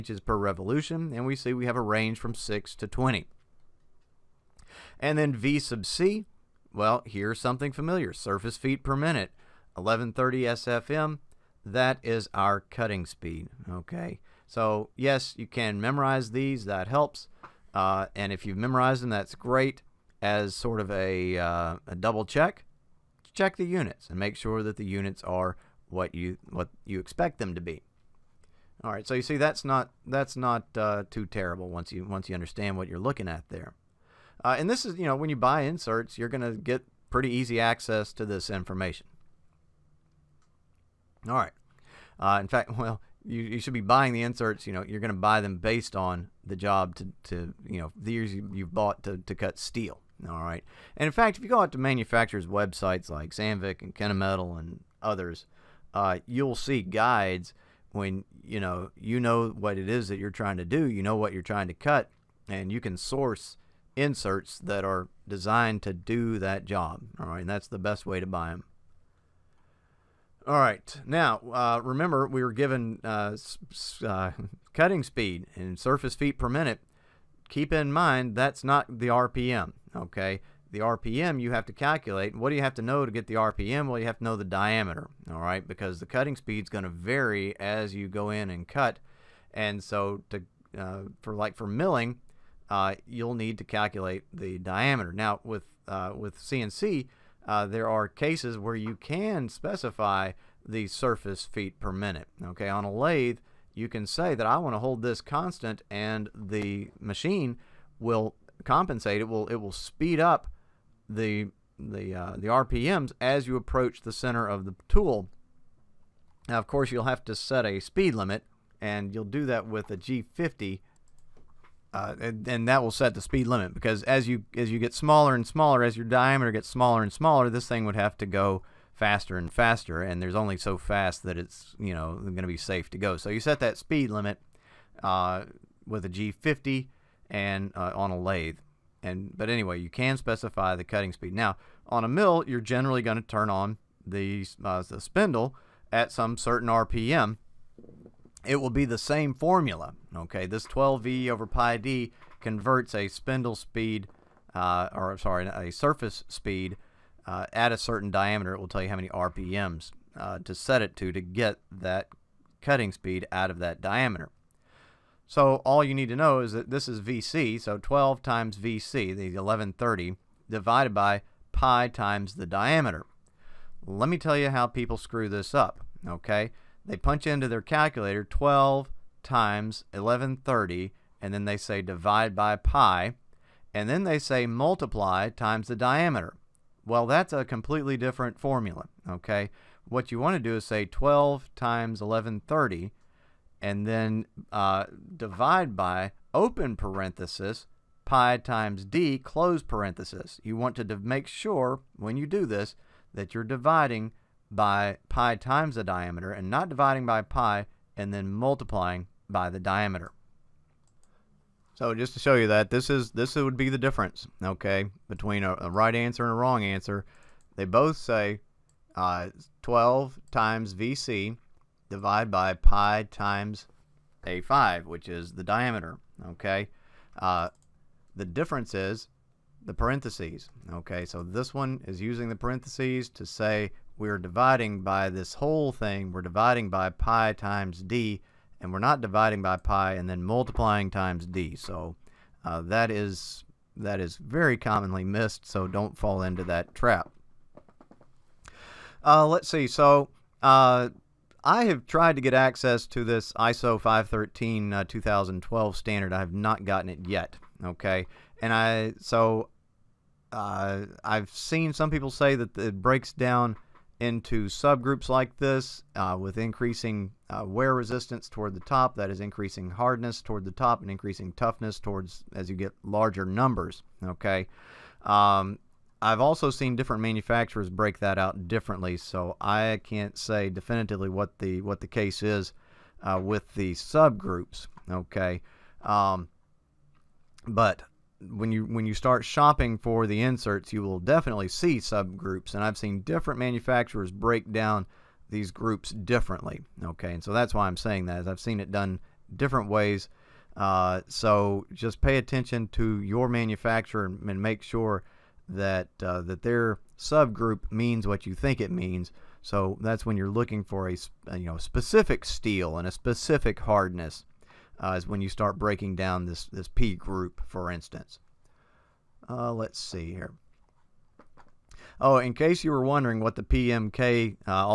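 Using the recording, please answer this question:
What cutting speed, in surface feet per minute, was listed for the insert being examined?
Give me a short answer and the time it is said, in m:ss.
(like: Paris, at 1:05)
1130 SFM, at 0:09.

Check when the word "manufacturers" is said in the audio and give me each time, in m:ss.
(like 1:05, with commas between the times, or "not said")
0:51, 4:37, 4:53, 5:03.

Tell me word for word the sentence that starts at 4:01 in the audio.
So uh, that is that is very commonly missed, so don't fall into that trap.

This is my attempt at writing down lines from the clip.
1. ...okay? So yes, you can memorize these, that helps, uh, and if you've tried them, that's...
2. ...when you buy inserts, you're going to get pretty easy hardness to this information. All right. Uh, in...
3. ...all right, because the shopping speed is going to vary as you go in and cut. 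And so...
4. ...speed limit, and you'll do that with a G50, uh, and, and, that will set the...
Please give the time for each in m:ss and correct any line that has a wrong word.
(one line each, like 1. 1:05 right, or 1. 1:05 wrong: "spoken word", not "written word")
1. 0:13 wrong: "memorized", not "tried"
2. 0:35 wrong: "access", not "hardness"
3. 1:25 wrong: "cutting", not "shopping"
4. 1:57 right.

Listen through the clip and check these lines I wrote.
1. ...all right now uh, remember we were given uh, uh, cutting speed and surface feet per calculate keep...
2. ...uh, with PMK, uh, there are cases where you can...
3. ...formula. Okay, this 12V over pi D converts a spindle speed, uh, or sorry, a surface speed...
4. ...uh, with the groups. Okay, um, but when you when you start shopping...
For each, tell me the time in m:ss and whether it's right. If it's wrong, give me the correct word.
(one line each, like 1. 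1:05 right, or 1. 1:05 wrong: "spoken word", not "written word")
1. 1:10 wrong: "minute", not "calculate"
2. 1:35 wrong: "CNC", not "PMK"
3. 2:29 right
4. 4:43 wrong: "subgroups", not "groups".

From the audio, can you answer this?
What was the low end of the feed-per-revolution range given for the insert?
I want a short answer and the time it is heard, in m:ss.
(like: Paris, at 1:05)
6, at 0:02.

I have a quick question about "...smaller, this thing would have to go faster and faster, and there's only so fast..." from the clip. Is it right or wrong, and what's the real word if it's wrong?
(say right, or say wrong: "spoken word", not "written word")
right.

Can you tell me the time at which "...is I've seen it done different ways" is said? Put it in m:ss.
4:58.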